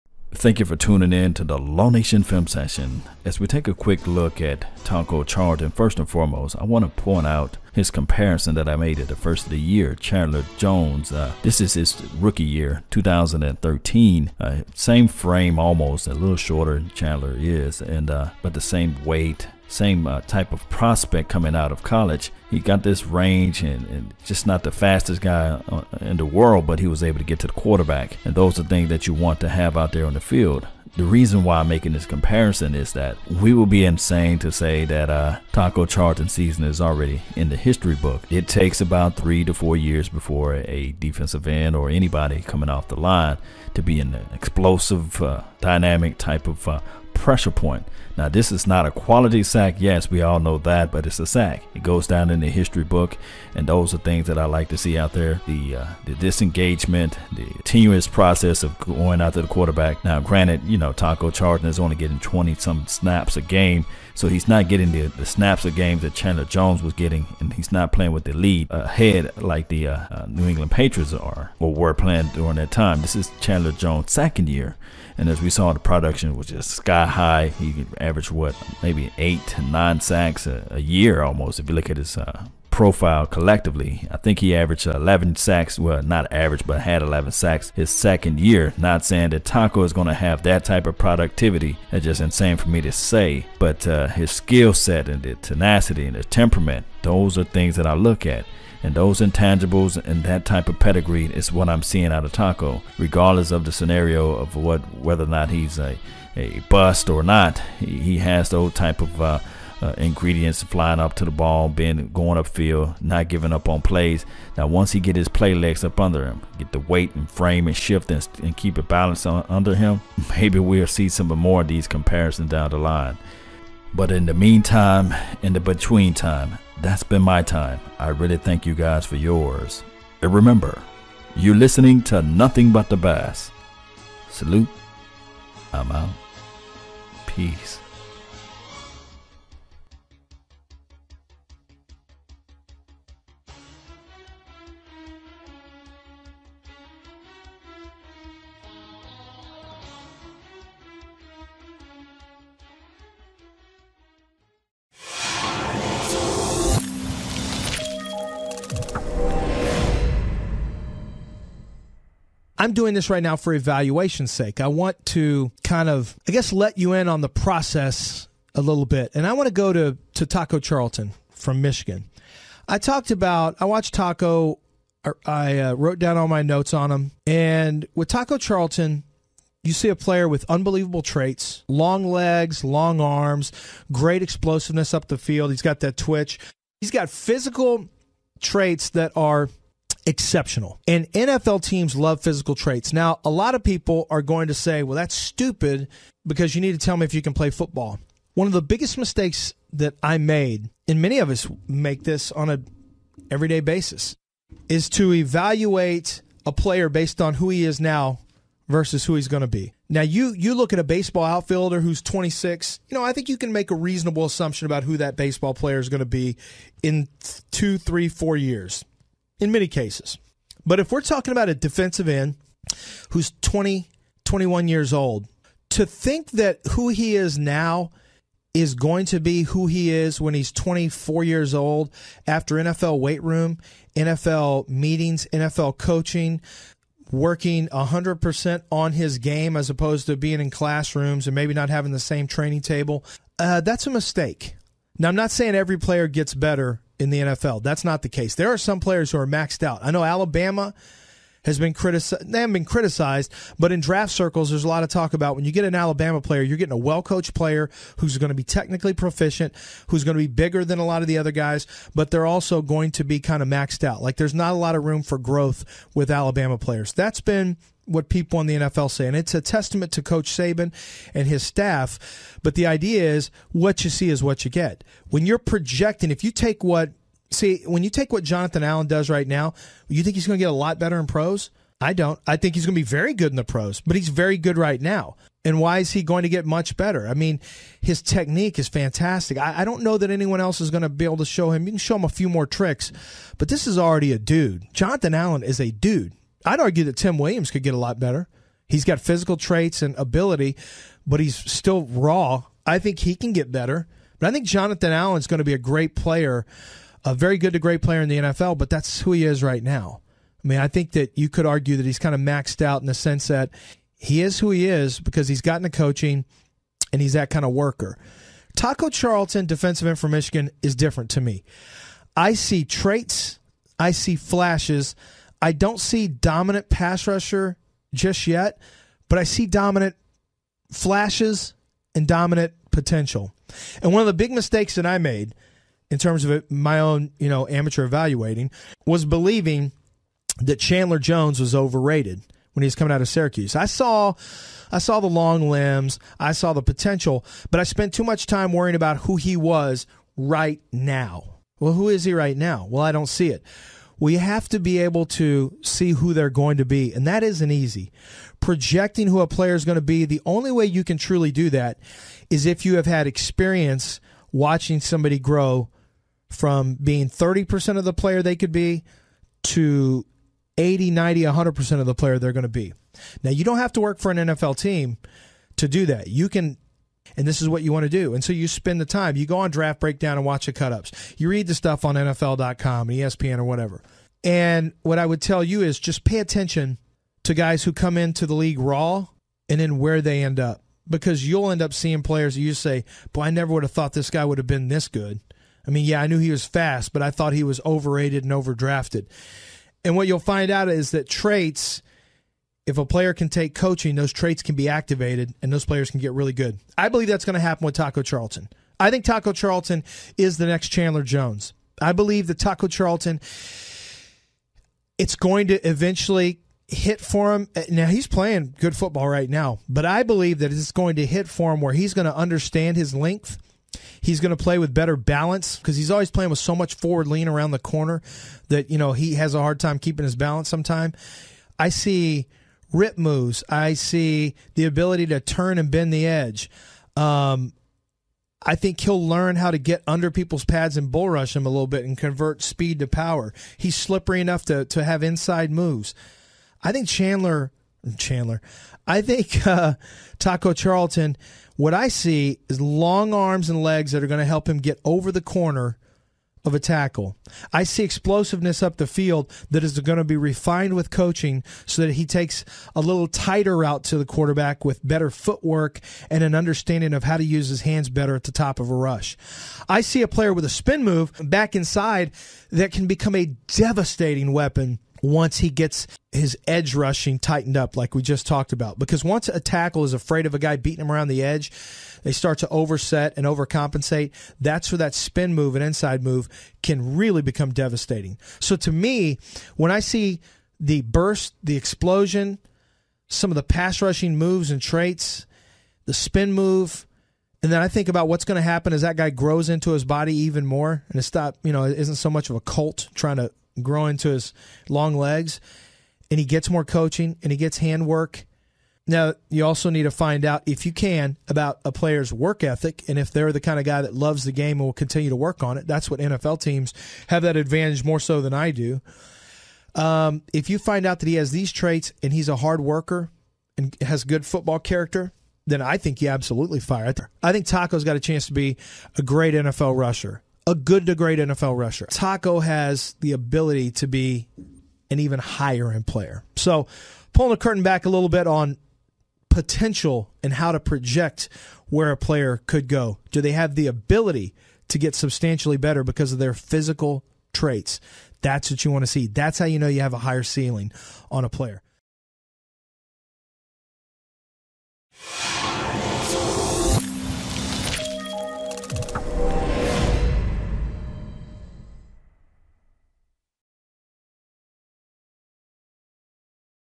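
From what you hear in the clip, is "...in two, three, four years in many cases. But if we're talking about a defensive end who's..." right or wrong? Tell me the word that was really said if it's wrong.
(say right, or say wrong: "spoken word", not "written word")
right.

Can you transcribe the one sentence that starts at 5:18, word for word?
Taco Charlton, defensive end for Michigan, is different to me.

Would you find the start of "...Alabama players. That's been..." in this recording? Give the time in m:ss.
4:26.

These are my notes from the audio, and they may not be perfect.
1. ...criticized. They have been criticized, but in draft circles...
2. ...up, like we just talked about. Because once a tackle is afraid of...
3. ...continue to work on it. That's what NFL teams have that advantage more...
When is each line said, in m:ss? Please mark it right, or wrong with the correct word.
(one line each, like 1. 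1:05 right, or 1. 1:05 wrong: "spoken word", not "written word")
1. 4:11 right
2. 7:57 right
3. 8:34 right.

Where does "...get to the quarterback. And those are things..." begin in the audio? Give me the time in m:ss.
0:27.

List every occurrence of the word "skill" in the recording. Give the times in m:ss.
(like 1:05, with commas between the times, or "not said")
1:34.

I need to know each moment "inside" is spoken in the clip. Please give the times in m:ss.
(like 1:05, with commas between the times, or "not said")
7:25, 7:51, 8:05.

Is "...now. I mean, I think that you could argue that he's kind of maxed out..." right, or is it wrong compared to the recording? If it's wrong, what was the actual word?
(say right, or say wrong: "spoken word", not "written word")
right.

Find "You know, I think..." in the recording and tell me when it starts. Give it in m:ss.
3:32.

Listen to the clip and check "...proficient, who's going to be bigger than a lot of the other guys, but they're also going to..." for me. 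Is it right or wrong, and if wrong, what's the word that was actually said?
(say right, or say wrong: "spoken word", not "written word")
right.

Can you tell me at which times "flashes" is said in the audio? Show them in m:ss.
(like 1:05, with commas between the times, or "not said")
5:24, 5:30.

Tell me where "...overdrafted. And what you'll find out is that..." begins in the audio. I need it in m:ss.
6:38.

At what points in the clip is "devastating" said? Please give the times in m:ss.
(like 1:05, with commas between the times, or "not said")
7:53, 8:07.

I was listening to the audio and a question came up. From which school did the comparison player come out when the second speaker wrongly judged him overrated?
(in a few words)
Syracuse.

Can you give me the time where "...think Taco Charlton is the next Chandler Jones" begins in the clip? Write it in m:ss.
6:48.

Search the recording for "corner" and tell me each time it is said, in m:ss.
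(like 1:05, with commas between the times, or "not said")
7:07, 7:35.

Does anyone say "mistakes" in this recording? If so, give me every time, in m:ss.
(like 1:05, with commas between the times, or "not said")
3:18, 4:03, 5:34.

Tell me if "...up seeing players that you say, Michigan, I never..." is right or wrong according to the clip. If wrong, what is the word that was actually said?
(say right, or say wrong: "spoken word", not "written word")
wrong: "Boy", not "Michigan".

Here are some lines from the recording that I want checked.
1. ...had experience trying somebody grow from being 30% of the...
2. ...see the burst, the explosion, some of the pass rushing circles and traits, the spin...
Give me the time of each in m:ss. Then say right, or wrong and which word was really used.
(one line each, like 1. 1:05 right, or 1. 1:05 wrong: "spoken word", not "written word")
1. 6:02 wrong: "watching", not "trying"
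2. 8:09 wrong: "moves", not "circles".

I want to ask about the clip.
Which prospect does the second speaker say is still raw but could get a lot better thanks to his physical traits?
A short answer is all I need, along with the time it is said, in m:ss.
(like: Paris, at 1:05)
Tim Williams, at 4:56.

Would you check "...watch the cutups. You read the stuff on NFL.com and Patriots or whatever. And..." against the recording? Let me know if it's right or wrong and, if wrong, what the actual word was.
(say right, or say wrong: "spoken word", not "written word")
wrong: "ESPN", not "Patriots".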